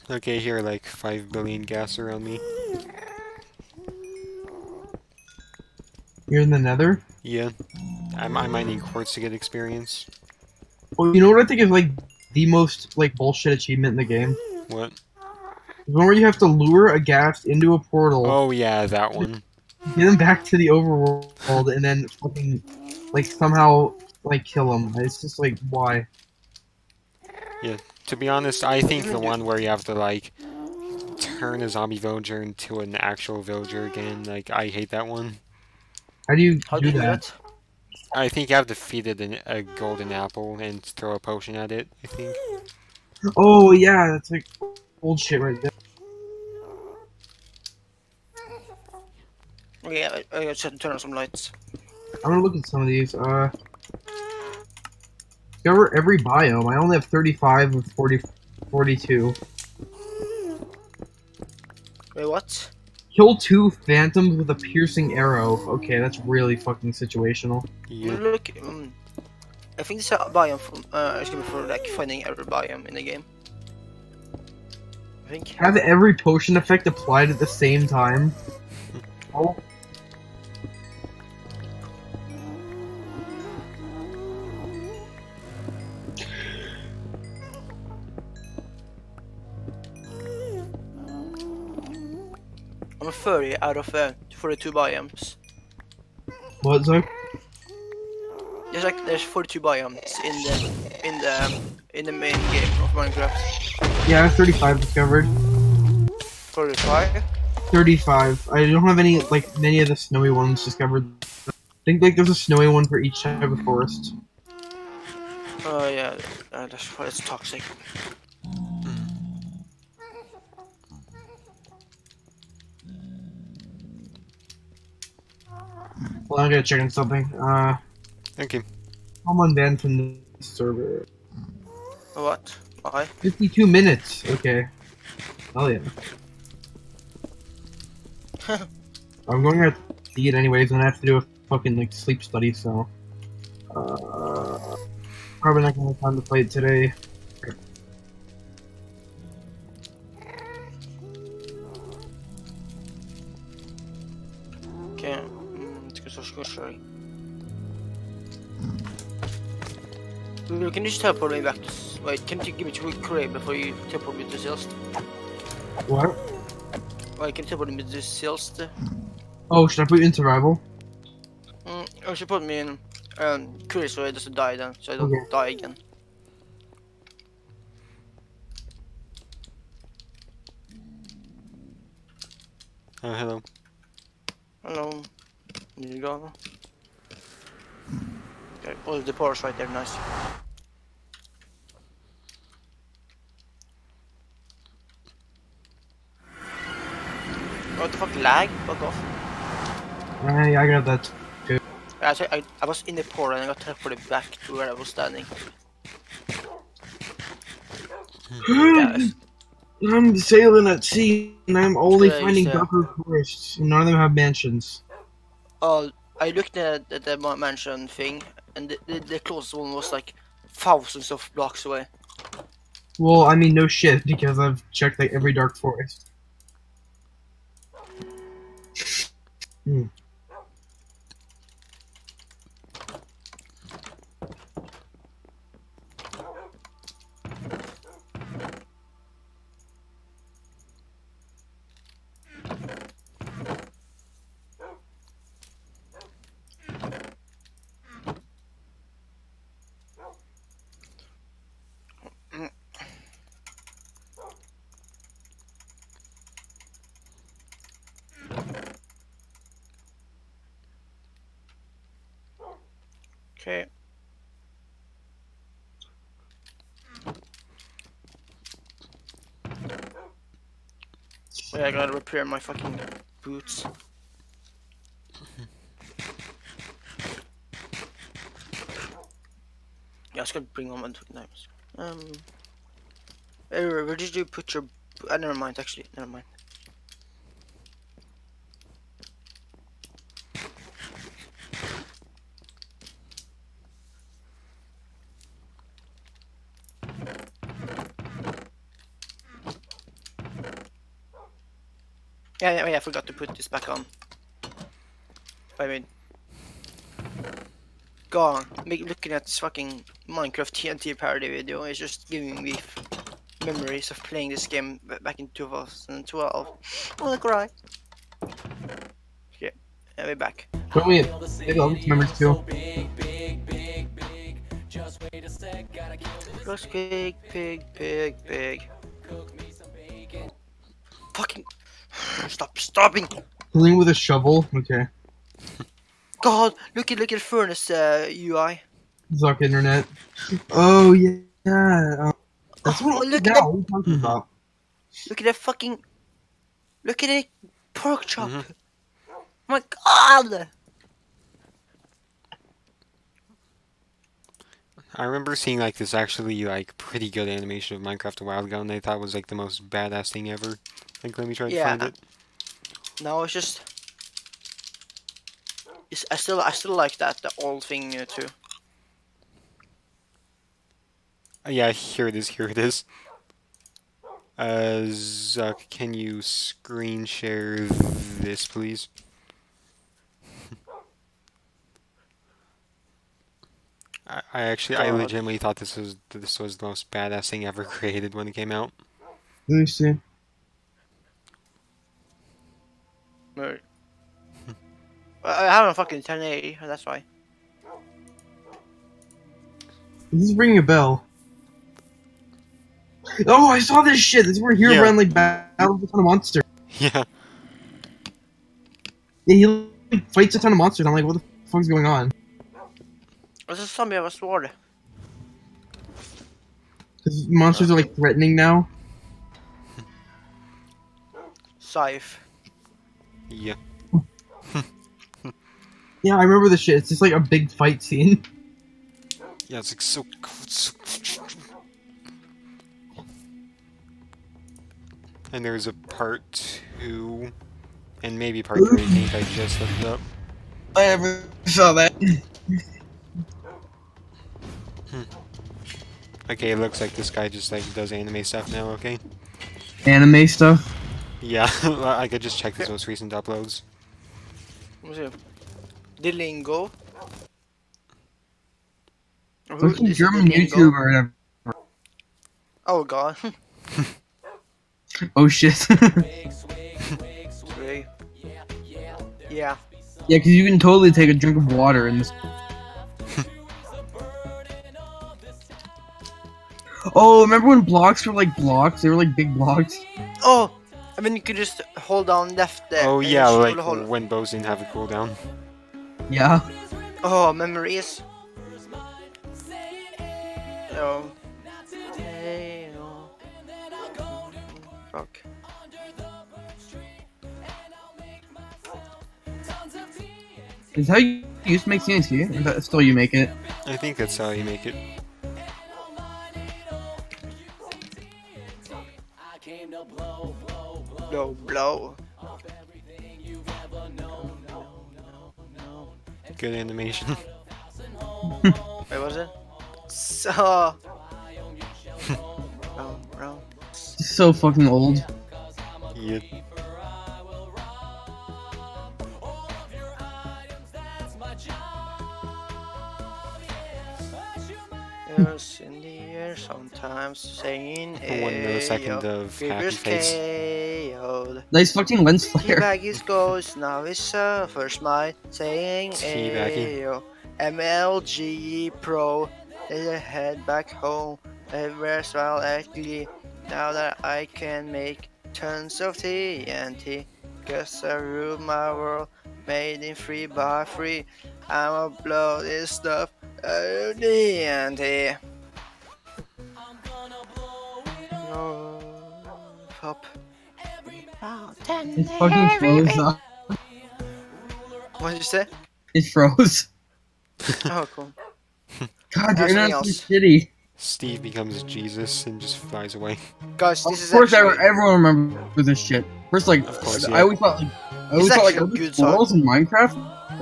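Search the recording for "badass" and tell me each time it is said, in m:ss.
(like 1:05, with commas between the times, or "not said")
5:59, 6:26.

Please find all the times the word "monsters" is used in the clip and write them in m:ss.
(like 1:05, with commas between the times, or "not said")
6:46, 6:50, 6:57.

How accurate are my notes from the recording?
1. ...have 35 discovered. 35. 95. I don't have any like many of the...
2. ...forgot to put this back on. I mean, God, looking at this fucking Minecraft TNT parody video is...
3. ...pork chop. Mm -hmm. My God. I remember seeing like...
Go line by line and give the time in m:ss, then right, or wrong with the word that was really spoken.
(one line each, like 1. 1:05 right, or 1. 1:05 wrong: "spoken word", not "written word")
1. 1:44 wrong: "35", not "95"
2. 5:02 right
3. 5:47 right.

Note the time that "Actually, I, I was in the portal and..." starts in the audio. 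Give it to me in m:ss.
3:22.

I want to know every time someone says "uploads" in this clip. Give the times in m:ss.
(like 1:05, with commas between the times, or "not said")
7:33.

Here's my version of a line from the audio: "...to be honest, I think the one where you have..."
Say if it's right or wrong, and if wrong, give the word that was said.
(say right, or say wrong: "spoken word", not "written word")
right.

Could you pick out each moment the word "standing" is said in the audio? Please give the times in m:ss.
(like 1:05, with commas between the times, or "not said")
3:24.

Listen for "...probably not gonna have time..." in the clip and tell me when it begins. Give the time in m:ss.
2:25.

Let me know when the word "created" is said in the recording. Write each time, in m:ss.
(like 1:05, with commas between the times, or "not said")
6:27.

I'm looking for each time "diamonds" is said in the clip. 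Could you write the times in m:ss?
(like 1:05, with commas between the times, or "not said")
4:41.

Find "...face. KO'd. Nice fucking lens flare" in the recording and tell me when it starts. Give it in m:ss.
8:59.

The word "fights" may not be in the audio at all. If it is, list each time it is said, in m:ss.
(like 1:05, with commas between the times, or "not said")
6:50, 7:07.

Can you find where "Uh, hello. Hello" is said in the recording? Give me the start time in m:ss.
3:03.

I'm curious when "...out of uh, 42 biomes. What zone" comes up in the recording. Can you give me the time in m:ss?
1:33.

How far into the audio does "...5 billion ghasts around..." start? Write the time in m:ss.
0:00.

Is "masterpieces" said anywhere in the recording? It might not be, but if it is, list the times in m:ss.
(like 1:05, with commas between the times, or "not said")
not said.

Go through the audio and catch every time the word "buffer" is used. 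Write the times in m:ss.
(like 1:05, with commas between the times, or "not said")
3:32.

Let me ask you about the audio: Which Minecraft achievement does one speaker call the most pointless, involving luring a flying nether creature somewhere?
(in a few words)
Lure a ghast into a portal.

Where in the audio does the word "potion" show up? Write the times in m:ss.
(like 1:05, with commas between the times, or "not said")
0:41, 1:16.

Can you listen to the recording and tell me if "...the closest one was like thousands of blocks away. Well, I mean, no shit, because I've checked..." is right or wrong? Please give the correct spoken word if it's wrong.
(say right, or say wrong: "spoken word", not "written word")
right.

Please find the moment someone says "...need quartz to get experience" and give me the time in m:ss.
0:08.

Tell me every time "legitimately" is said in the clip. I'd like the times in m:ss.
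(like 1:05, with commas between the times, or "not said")
6:24.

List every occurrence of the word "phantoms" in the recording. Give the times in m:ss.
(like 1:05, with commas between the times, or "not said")
1:03.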